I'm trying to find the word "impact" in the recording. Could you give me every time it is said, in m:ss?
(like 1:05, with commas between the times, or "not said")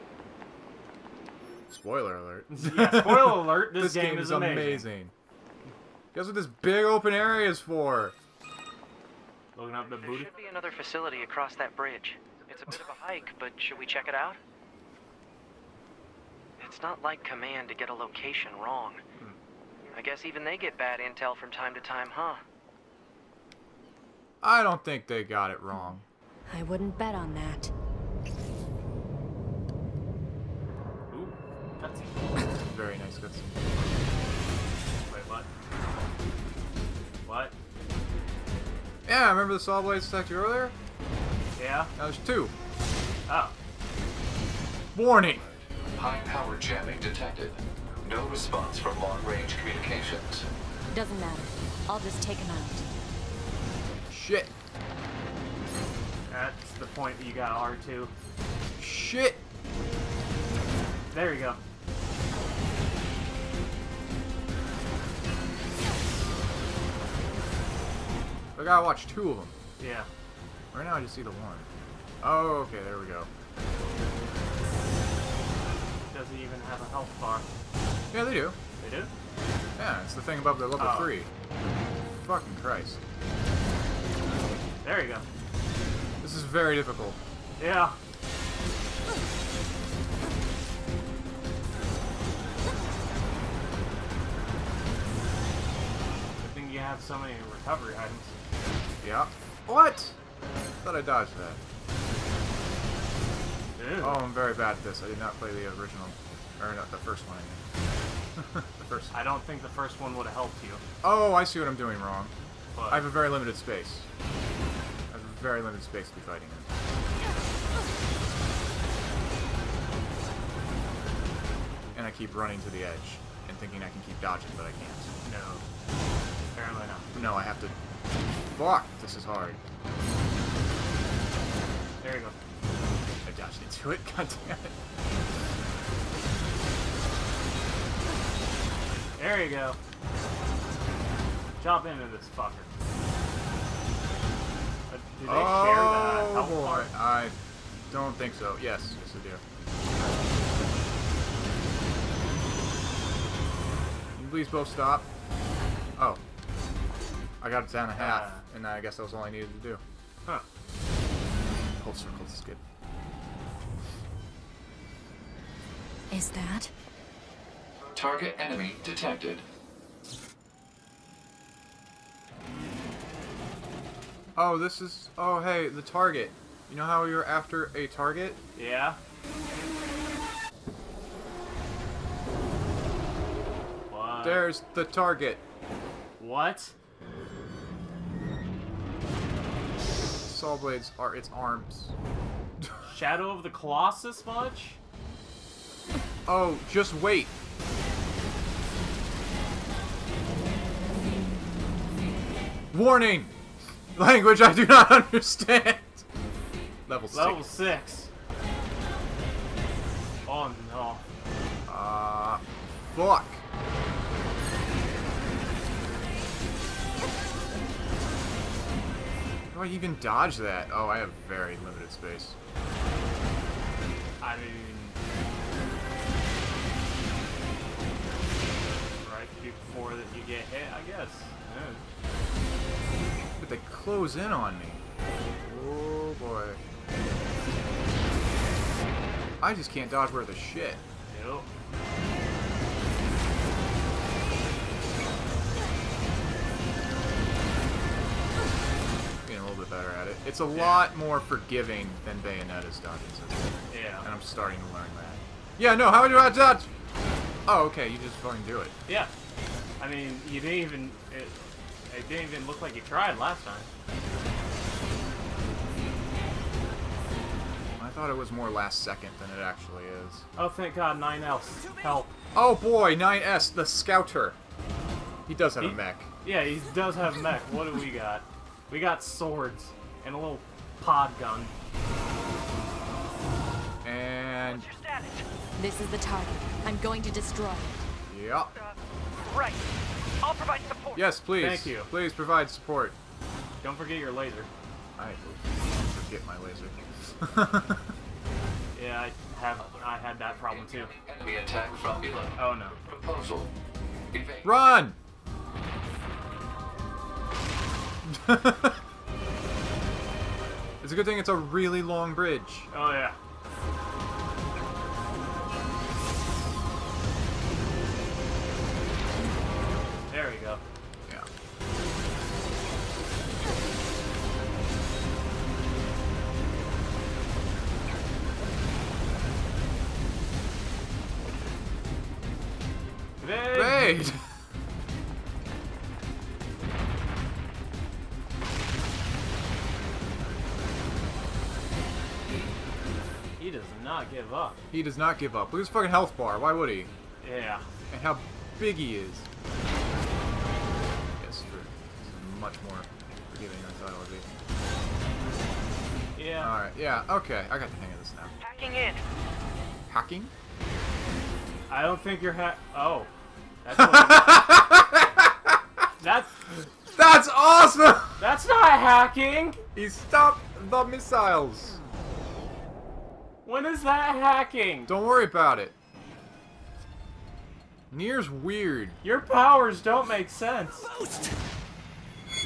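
not said.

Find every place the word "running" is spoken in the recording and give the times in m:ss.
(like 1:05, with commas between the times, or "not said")
2:02.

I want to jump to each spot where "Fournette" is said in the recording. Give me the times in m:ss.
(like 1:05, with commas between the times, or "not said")
not said.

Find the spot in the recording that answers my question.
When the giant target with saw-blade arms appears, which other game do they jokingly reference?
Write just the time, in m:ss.
3:12.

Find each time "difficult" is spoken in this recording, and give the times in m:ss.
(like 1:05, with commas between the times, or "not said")
1:26.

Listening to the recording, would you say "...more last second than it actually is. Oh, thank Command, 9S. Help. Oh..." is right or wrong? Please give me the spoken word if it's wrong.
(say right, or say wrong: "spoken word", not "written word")
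wrong: "God", not "Command".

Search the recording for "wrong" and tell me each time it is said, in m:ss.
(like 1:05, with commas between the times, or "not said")
0:18, 0:25, 1:52.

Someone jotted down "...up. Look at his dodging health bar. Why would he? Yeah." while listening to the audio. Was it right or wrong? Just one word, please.
wrong.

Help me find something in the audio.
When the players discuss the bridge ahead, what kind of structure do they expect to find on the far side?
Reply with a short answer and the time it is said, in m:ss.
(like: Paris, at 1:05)
Another facility, at 0:10.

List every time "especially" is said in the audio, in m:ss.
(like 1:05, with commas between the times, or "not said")
not said.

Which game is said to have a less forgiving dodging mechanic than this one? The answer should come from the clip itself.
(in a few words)
Bayonetta.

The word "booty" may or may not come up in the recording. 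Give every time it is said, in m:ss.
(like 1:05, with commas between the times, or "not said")
0:09.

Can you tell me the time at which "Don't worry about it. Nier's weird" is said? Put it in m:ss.
6:14.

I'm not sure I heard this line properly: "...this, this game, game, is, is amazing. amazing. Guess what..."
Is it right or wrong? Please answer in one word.
right.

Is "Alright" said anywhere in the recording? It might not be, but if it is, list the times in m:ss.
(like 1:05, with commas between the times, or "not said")
5:56.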